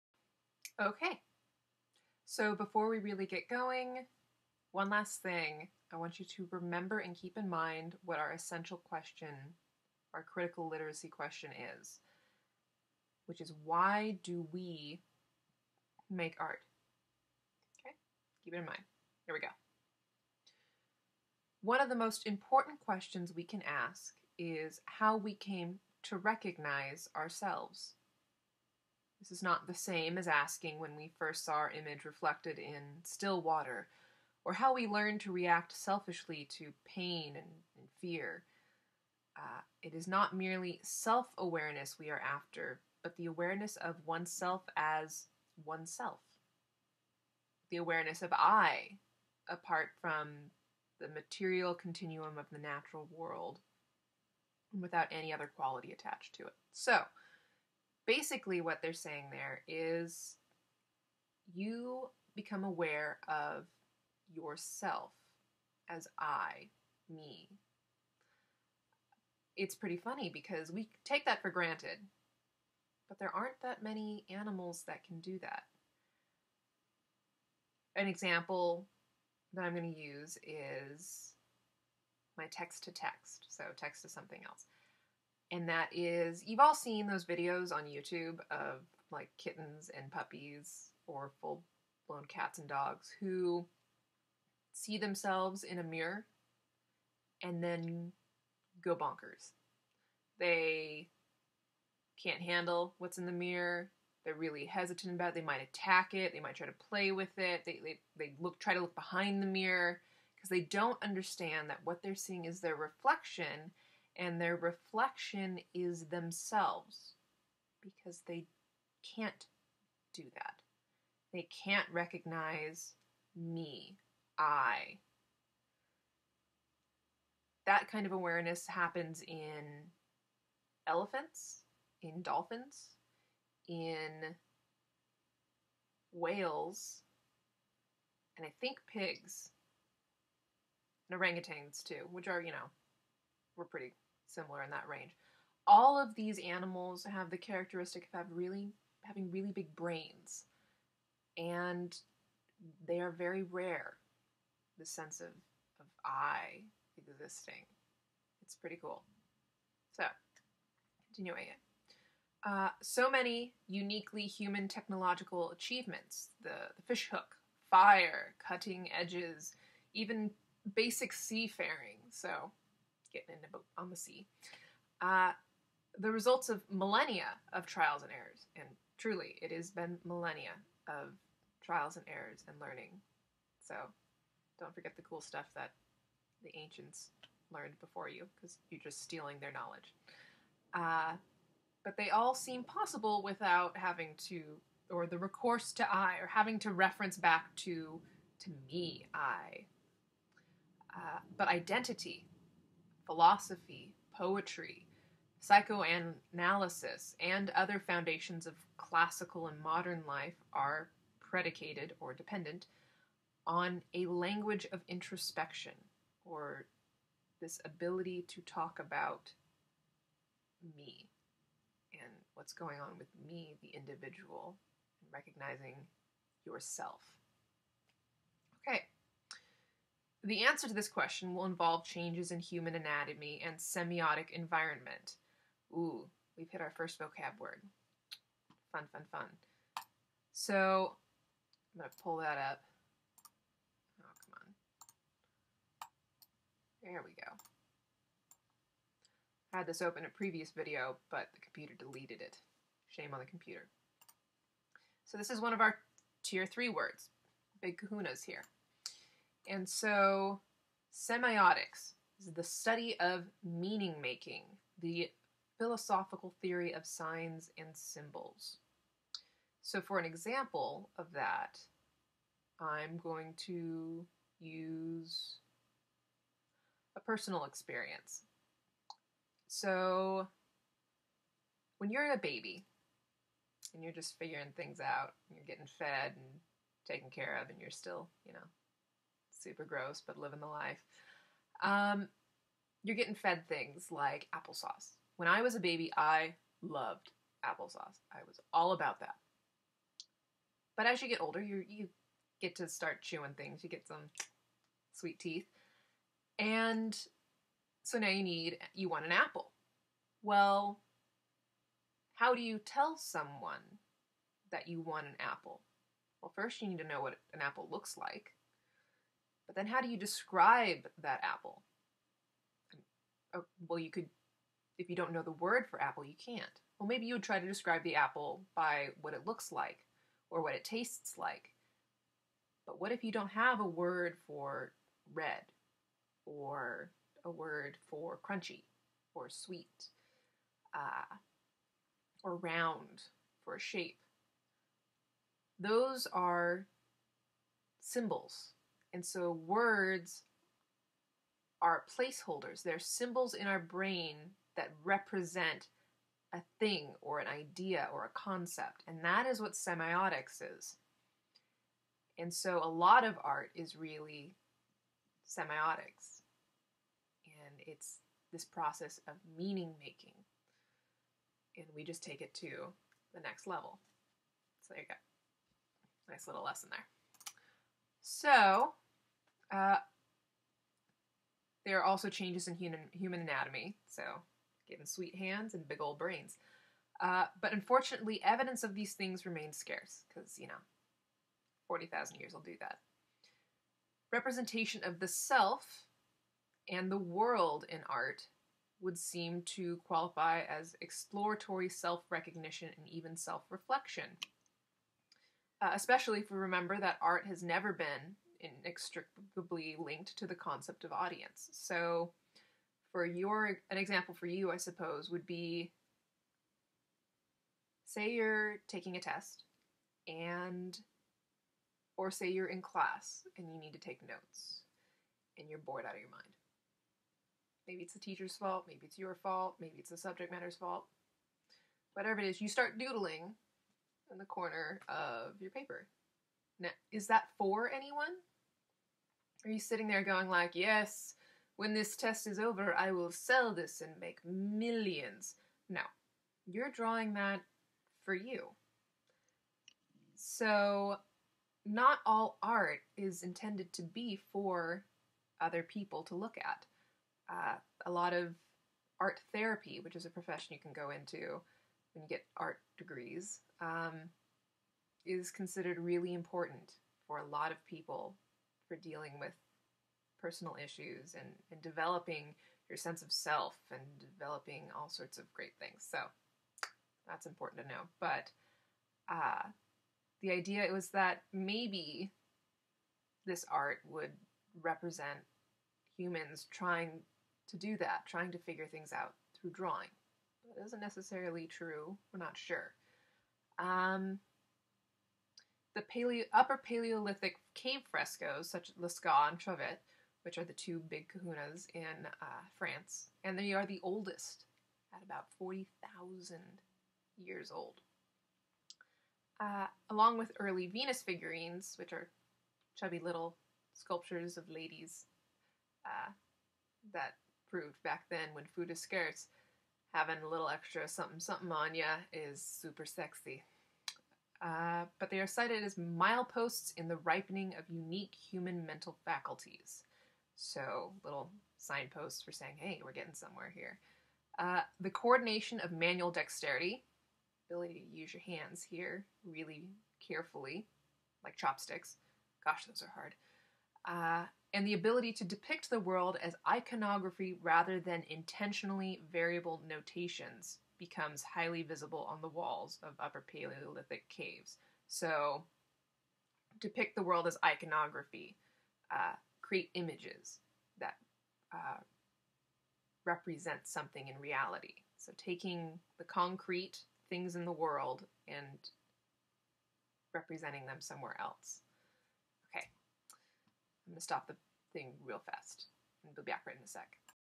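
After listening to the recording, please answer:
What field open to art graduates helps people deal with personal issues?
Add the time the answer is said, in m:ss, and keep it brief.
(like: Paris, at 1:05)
Art therapy, at 7:38.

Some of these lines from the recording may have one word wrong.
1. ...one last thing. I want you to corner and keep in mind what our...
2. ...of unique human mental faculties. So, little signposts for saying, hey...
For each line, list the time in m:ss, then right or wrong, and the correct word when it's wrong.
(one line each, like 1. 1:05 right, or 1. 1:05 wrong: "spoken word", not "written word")
1. 0:04 wrong: "remember", not "corner"
2. 8:47 right.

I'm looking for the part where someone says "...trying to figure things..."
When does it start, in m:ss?
8:08.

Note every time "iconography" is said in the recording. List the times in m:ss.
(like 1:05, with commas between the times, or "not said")
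9:06, 9:17.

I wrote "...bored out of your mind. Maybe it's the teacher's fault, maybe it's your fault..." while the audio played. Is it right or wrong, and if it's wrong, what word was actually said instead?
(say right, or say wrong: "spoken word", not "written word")
right.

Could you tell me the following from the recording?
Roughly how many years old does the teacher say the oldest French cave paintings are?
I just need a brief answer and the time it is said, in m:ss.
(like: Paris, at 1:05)
40,000 years, at 8:25.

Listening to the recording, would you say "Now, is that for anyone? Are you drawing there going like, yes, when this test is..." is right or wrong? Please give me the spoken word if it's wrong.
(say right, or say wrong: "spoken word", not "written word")
wrong: "sitting", not "drawing".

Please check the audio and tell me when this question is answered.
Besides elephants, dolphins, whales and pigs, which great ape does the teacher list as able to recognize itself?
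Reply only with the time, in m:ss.
2:21.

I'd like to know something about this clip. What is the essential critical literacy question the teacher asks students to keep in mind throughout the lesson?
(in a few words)
Why do we make art?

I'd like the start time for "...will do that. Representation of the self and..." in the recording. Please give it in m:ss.
6:32.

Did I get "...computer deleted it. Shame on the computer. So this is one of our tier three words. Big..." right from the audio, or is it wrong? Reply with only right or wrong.
right.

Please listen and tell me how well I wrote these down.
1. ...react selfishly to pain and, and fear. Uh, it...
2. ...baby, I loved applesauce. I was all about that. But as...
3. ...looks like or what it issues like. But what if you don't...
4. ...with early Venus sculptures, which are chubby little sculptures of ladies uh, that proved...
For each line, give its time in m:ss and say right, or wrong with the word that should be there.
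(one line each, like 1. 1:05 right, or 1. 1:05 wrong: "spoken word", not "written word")
1. 0:35 right
2. 4:55 right
3. 5:29 wrong: "tastes", not "issues"
4. 8:30 wrong: "figurines", not "sculptures".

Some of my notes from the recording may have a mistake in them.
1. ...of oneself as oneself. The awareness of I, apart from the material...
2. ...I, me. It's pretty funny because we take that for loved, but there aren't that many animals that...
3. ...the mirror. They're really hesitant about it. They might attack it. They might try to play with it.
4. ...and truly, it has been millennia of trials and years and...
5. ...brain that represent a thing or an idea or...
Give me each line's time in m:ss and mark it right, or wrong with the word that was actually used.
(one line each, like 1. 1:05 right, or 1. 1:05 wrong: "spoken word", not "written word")
1. 0:43 right
2. 1:06 wrong: "granted", not "loved"
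3. 1:43 right
4. 2:58 wrong: "errors", not "years"
5. 5:53 right.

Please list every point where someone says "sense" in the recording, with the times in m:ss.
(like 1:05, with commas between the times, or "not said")
2:34, 7:52.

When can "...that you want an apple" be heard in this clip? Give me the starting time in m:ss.
5:14.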